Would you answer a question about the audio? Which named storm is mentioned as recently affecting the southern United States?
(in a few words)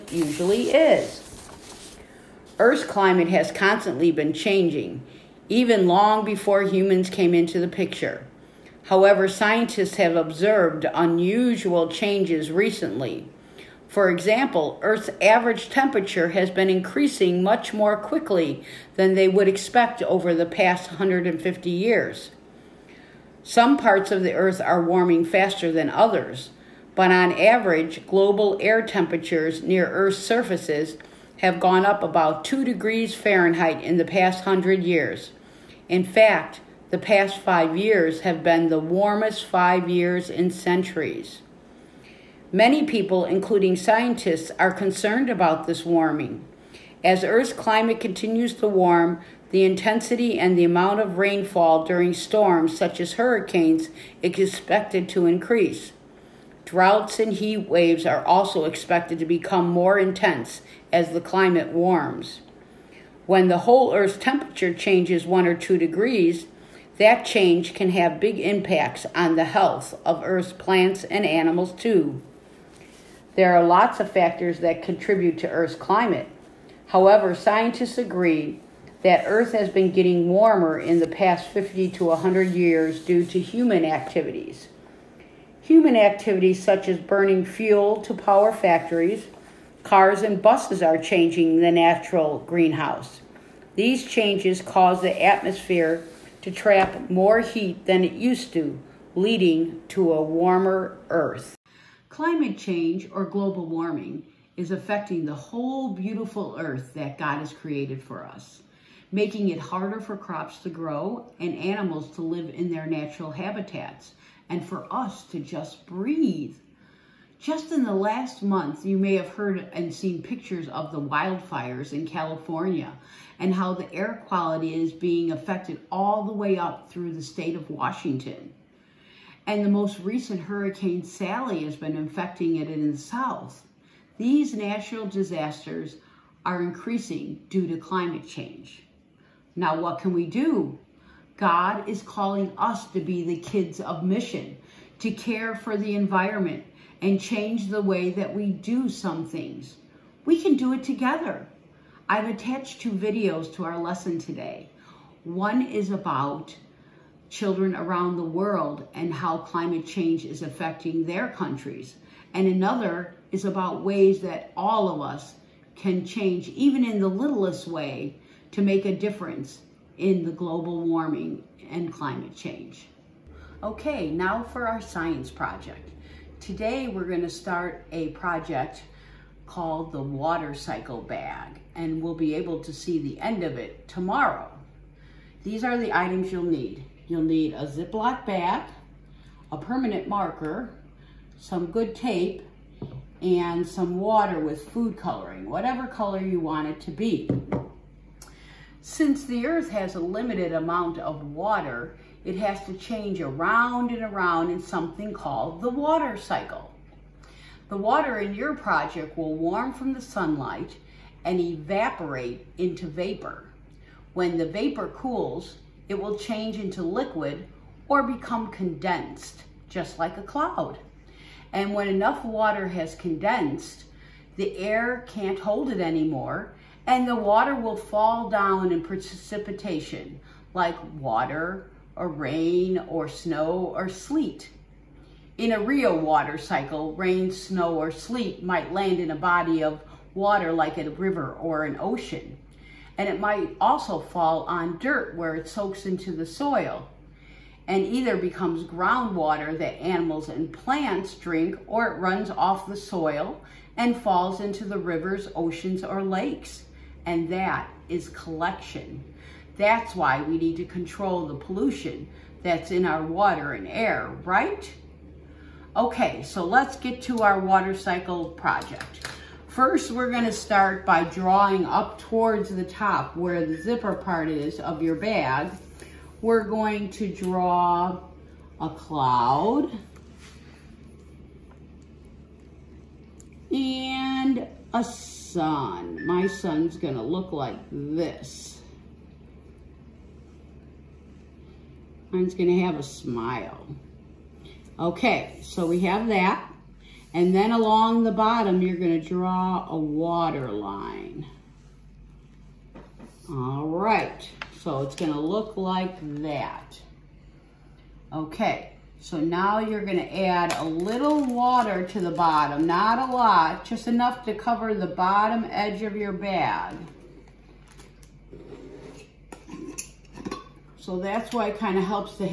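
Hurricane Sally.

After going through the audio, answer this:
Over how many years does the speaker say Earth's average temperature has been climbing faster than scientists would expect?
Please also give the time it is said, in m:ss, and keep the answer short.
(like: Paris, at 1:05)
150 years, at 0:20.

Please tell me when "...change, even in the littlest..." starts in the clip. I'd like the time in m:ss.
2:46.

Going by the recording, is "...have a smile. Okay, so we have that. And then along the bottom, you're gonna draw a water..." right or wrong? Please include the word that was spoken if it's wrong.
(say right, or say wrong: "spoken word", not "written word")
right.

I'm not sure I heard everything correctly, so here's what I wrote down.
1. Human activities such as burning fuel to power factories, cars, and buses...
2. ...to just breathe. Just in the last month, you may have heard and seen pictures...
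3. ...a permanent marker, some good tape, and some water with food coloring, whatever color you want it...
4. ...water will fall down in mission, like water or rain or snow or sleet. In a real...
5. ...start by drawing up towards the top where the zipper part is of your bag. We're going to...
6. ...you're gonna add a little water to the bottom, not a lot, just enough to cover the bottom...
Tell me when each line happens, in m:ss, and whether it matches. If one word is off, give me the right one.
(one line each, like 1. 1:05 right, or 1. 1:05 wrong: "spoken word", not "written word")
1. 1:25 right
2. 1:55 right
3. 3:09 right
4. 3:47 wrong: "precipitation", not "mission"
5. 4:30 right
6. 5:09 right.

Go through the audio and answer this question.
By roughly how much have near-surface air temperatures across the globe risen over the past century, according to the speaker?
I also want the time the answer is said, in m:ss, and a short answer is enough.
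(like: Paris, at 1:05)
2 degrees Fahrenheit, at 0:32.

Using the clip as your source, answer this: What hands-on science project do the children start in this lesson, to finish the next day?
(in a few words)
water cycle bag.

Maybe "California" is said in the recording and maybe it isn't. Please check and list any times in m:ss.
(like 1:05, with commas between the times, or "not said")
2:02.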